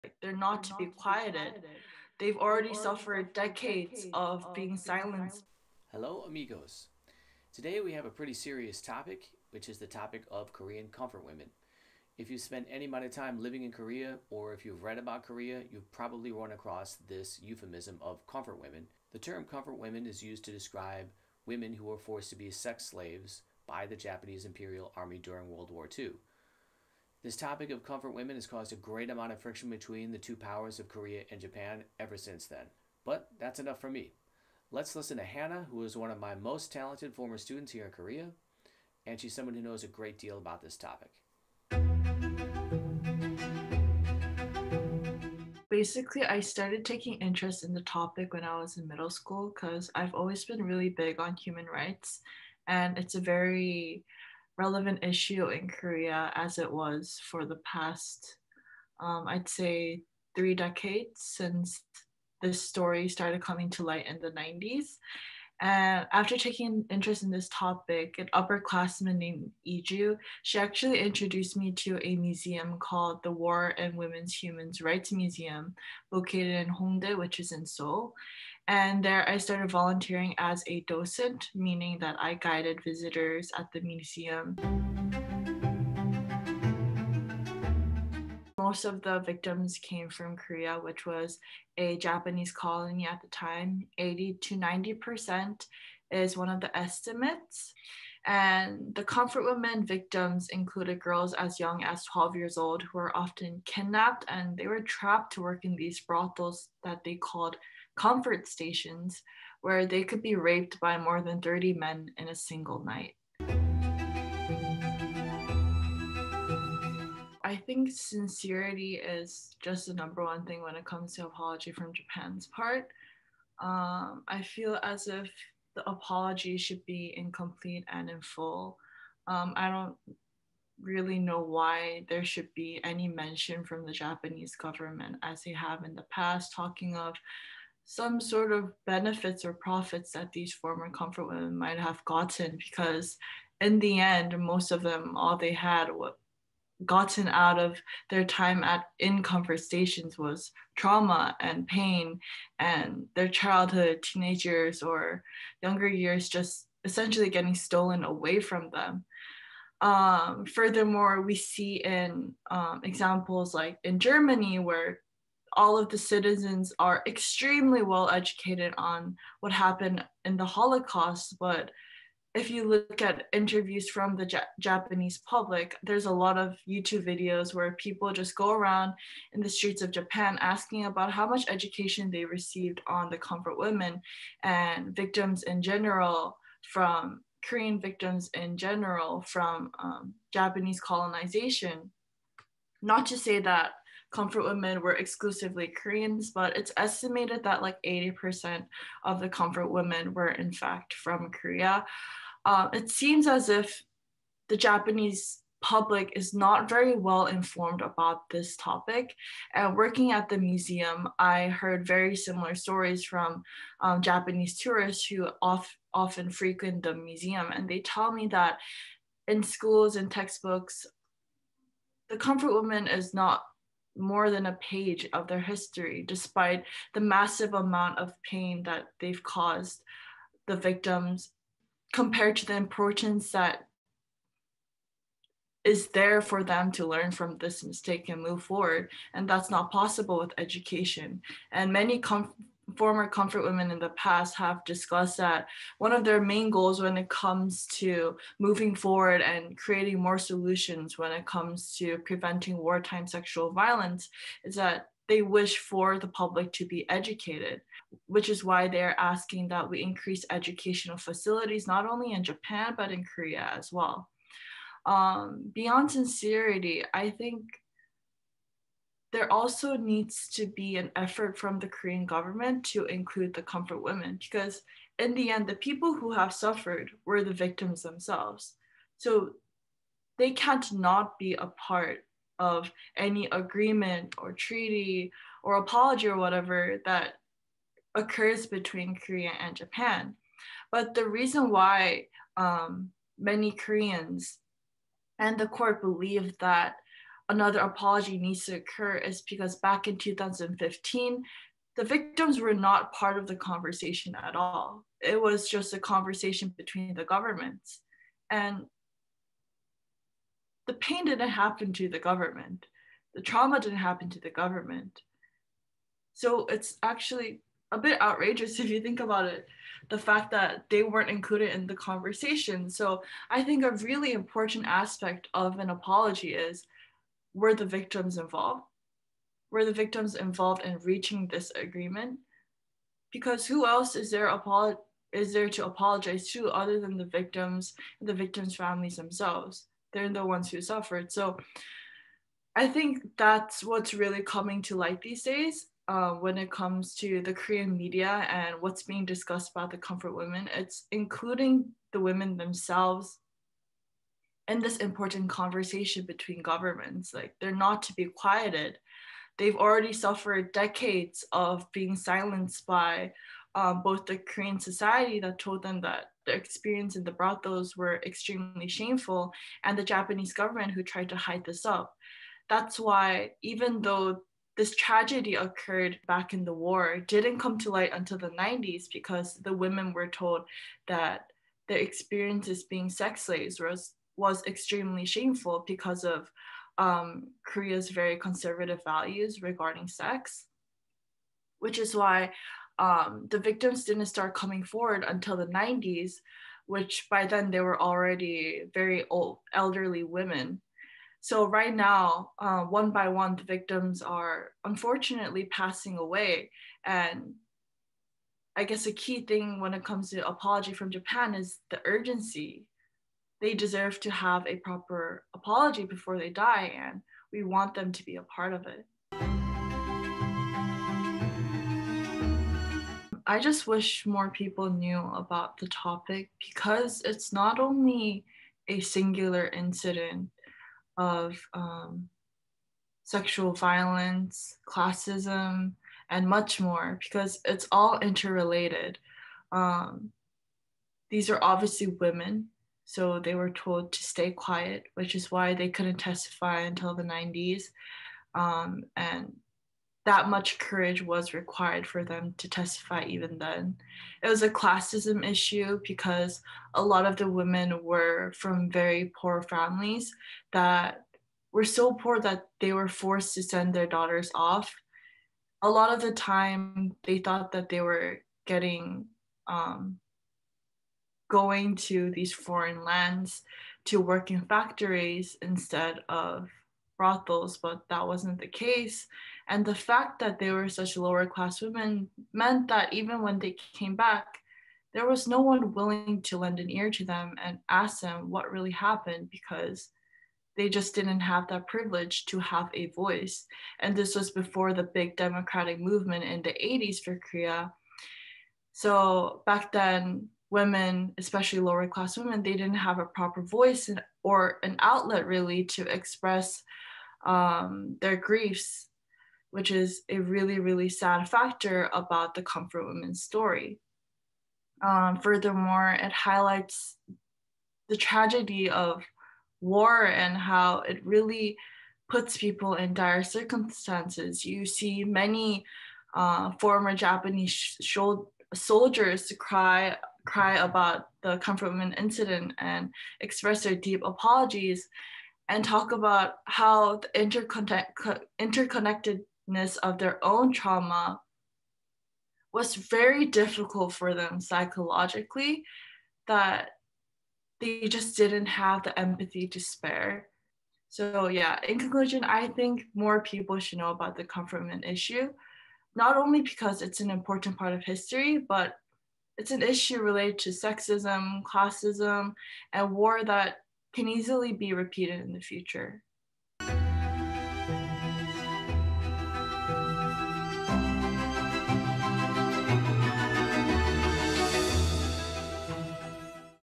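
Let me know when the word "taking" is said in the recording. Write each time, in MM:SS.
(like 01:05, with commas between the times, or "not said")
00:46, 01:06.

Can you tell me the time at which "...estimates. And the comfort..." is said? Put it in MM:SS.
01:36.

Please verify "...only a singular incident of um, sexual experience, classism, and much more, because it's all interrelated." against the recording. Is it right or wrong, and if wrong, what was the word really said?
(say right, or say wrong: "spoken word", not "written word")
wrong: "violence", not "experience".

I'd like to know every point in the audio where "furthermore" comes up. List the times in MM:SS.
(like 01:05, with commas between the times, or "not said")
02:40, 08:35.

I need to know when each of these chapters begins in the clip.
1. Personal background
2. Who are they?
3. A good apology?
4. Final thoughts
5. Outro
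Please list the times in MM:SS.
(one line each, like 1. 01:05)
1. 00:42
2. 01:24
3. 01:52
4. 06:59
5. 09:26.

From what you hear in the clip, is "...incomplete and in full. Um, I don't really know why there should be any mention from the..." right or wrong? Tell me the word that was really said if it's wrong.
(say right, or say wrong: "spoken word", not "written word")
right.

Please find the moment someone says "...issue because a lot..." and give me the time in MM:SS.
07:35.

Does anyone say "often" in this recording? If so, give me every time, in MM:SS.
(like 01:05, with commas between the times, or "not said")
01:43, 03:35.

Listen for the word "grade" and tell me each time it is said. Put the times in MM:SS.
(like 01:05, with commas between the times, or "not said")
not said.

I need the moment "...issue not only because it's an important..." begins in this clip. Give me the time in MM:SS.
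09:14.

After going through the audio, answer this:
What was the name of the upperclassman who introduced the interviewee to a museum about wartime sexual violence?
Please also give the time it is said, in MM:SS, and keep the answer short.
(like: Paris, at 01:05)
Iju, at 01:09.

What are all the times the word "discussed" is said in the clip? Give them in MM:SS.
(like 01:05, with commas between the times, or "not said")
04:04, 05:49.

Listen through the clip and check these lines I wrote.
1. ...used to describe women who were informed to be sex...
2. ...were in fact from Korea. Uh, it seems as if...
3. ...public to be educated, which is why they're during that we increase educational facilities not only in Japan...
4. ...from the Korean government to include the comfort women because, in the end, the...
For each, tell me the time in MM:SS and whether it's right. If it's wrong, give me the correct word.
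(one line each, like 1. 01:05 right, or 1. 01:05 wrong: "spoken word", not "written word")
1. 00:20 wrong: "forced", not "informed"
2. 03:20 right
3. 04:16 wrong: "asking", not "during"
4. 04:31 right.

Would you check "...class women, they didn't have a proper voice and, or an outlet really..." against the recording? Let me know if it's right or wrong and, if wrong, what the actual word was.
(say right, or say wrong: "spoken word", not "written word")
right.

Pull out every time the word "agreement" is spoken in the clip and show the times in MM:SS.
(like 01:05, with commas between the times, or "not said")
04:43, 05:31.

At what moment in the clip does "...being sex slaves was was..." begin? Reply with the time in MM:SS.
06:22.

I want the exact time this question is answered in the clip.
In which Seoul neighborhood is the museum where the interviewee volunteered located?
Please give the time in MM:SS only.
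01:16.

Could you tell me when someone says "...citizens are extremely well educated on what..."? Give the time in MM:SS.
02:45.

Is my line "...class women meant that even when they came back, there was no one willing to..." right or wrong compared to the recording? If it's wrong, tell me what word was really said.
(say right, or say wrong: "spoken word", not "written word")
right.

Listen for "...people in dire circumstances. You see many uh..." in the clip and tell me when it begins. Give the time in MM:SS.
08:42.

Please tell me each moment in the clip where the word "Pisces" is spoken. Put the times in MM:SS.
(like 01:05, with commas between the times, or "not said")
not said.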